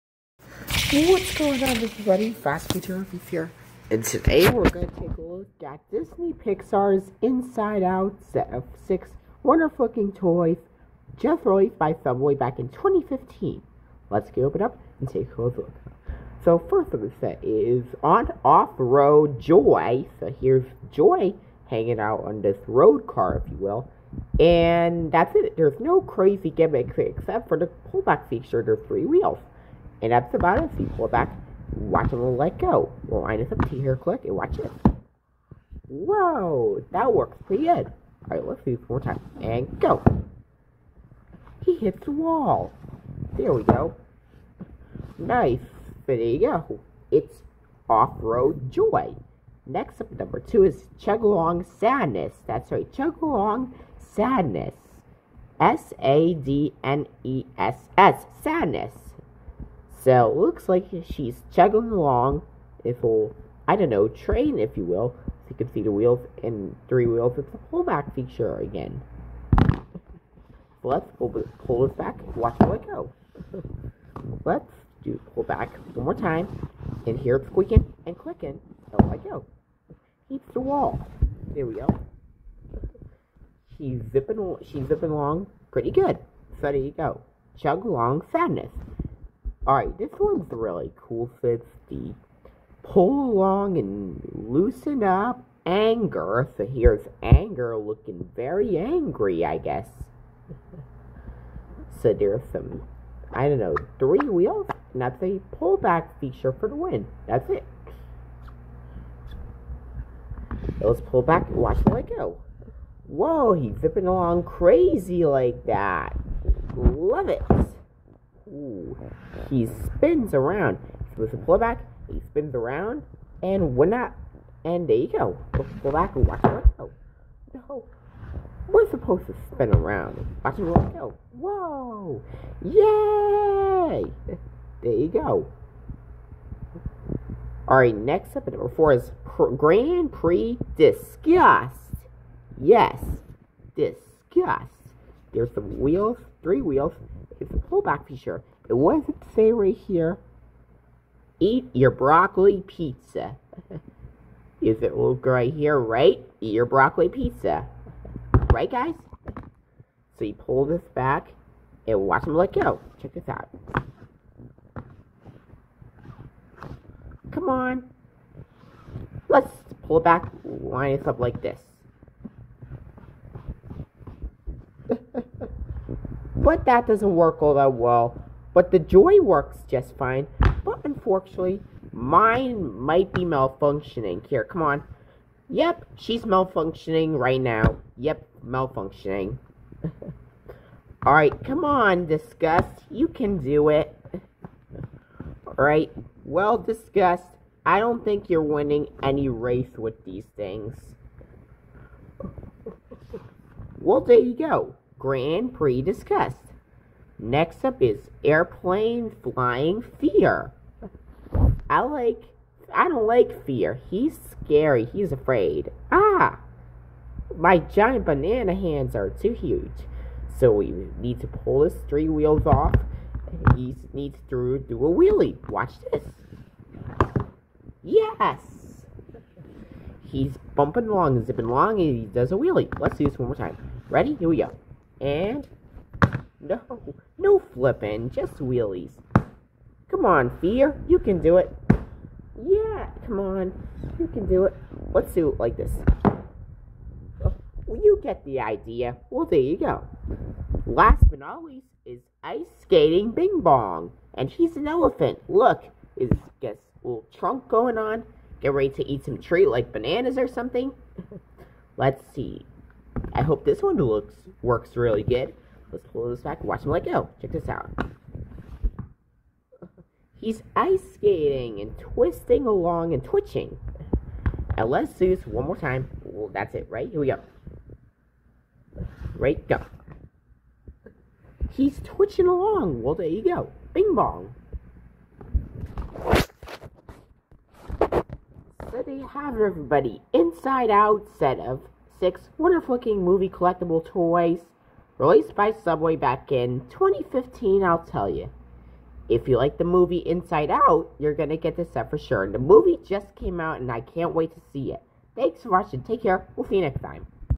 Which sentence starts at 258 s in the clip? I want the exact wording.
Get ready to eat some treat like bananas or something.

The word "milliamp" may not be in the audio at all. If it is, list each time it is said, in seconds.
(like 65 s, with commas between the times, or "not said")
not said.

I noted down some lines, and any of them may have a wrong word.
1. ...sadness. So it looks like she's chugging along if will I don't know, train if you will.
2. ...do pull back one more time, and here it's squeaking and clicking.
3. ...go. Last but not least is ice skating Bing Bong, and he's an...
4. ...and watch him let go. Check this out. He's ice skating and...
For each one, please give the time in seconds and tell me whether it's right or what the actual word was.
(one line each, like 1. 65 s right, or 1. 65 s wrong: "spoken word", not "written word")
1. 58 s right
2. 75 s right
3. 249 s right
4. 266 s right.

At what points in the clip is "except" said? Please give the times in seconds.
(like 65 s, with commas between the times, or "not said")
26 s.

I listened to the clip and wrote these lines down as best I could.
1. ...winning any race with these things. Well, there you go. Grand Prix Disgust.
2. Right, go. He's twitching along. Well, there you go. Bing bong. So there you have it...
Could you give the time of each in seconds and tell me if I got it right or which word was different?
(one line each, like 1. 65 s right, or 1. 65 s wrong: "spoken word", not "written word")
1. 198 s right
2. 279 s right.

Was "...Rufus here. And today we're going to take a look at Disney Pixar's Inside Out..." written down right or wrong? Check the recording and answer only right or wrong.
right.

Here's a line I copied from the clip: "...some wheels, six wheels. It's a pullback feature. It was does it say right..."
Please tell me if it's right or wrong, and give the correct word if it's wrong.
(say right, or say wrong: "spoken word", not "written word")
wrong: "three", not "six".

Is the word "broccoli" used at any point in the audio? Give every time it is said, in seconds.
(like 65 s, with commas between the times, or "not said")
151 s, 156 s.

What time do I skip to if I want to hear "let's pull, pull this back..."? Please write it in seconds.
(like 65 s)
70 s.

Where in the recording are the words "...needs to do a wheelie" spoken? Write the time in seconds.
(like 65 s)
223 s.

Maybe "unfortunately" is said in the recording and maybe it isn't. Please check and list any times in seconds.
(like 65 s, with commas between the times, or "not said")
180 s.